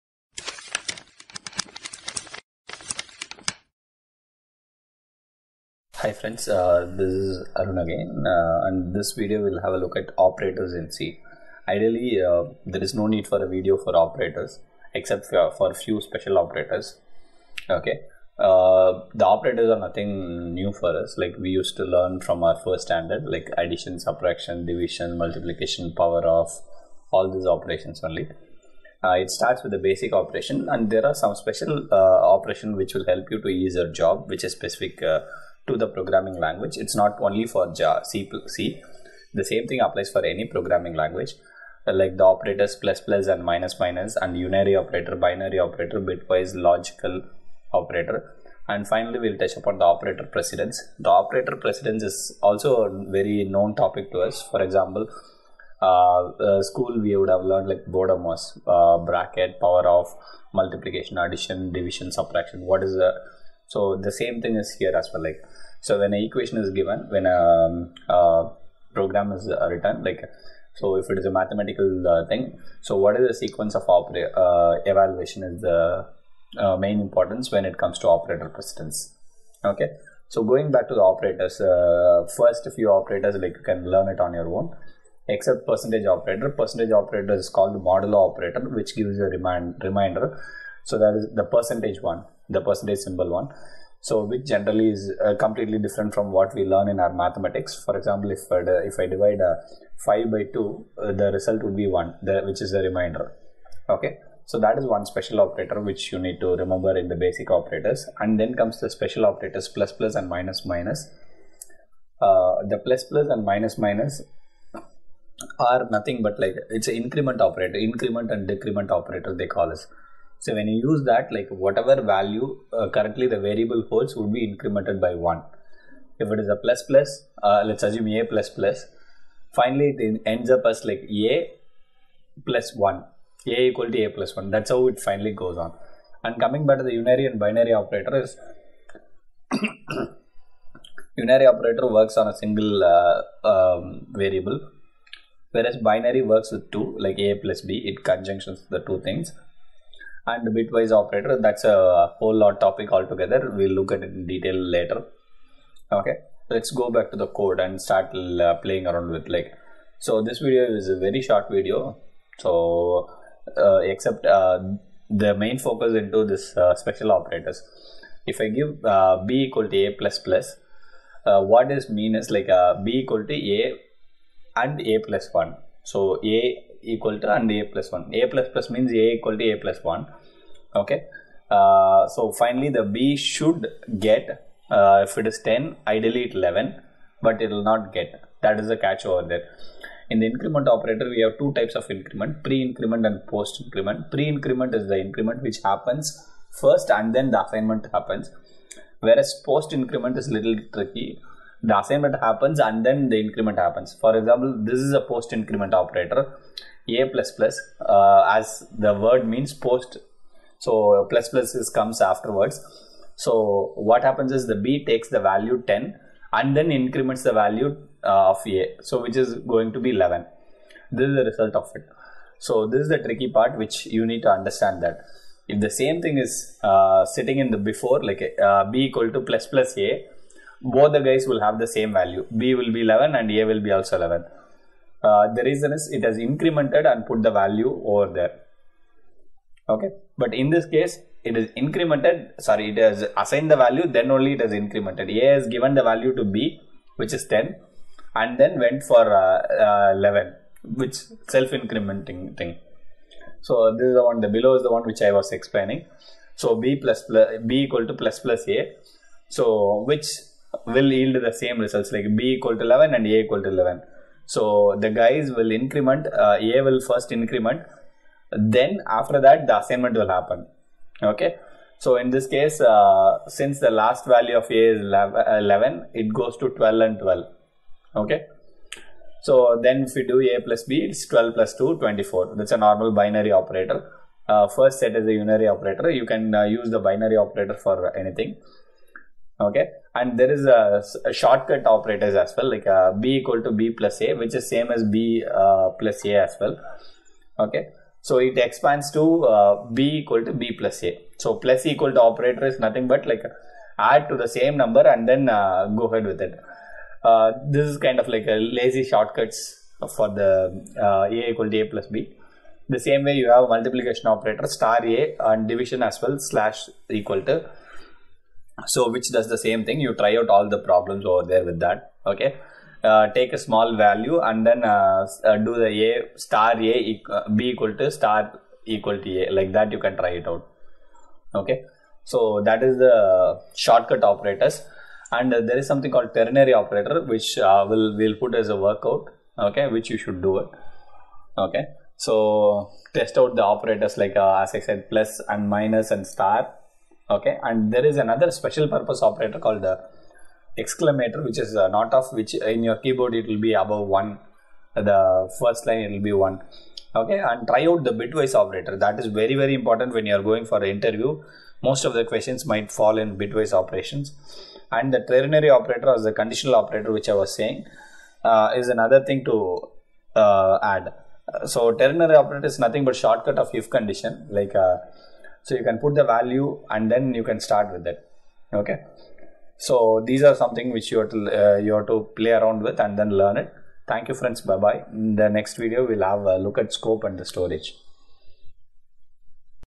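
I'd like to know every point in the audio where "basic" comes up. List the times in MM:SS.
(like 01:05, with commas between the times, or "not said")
00:29, 01:47.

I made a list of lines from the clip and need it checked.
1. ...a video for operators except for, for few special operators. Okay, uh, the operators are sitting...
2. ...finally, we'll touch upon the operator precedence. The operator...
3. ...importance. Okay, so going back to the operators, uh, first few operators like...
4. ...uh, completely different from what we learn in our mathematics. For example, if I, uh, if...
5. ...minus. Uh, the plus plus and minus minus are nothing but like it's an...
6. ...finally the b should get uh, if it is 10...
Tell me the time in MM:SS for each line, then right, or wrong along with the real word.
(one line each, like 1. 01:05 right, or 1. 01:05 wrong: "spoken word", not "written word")
1. 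00:13 wrong: "nothing", not "sitting"
2. 00:48 right
3. 01:18 wrong: "precedence", not "importance"
4. 01:35 right
5. 01:50 right
6. 03:02 right.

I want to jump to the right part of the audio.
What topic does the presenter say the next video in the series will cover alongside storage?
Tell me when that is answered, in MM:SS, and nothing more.
06:26.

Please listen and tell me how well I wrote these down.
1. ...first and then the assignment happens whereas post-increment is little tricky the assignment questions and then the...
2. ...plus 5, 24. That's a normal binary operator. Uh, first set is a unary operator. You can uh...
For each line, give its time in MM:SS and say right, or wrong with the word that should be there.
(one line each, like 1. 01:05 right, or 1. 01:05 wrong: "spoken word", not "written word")
1. 03:16 wrong: "happens", not "questions"
2. 04:41 wrong: "2", not "5".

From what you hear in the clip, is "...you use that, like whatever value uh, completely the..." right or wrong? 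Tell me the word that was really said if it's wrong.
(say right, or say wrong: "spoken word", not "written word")
wrong: "currently", not "completely".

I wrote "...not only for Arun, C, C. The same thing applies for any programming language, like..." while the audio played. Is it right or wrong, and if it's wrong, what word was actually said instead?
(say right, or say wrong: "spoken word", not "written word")
wrong: "Java", not "Arun".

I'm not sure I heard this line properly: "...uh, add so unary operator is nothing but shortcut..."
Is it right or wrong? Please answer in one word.
wrong.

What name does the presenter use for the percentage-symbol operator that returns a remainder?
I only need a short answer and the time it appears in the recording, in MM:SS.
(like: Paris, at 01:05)
modulo operator, at 01:27.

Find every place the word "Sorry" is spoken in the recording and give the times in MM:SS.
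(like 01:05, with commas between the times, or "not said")
04:02.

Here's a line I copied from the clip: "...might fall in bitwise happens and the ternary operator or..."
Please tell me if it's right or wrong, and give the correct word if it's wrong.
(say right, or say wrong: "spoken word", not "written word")
wrong: "operations", not "happens".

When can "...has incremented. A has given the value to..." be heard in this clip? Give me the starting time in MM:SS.
04:04.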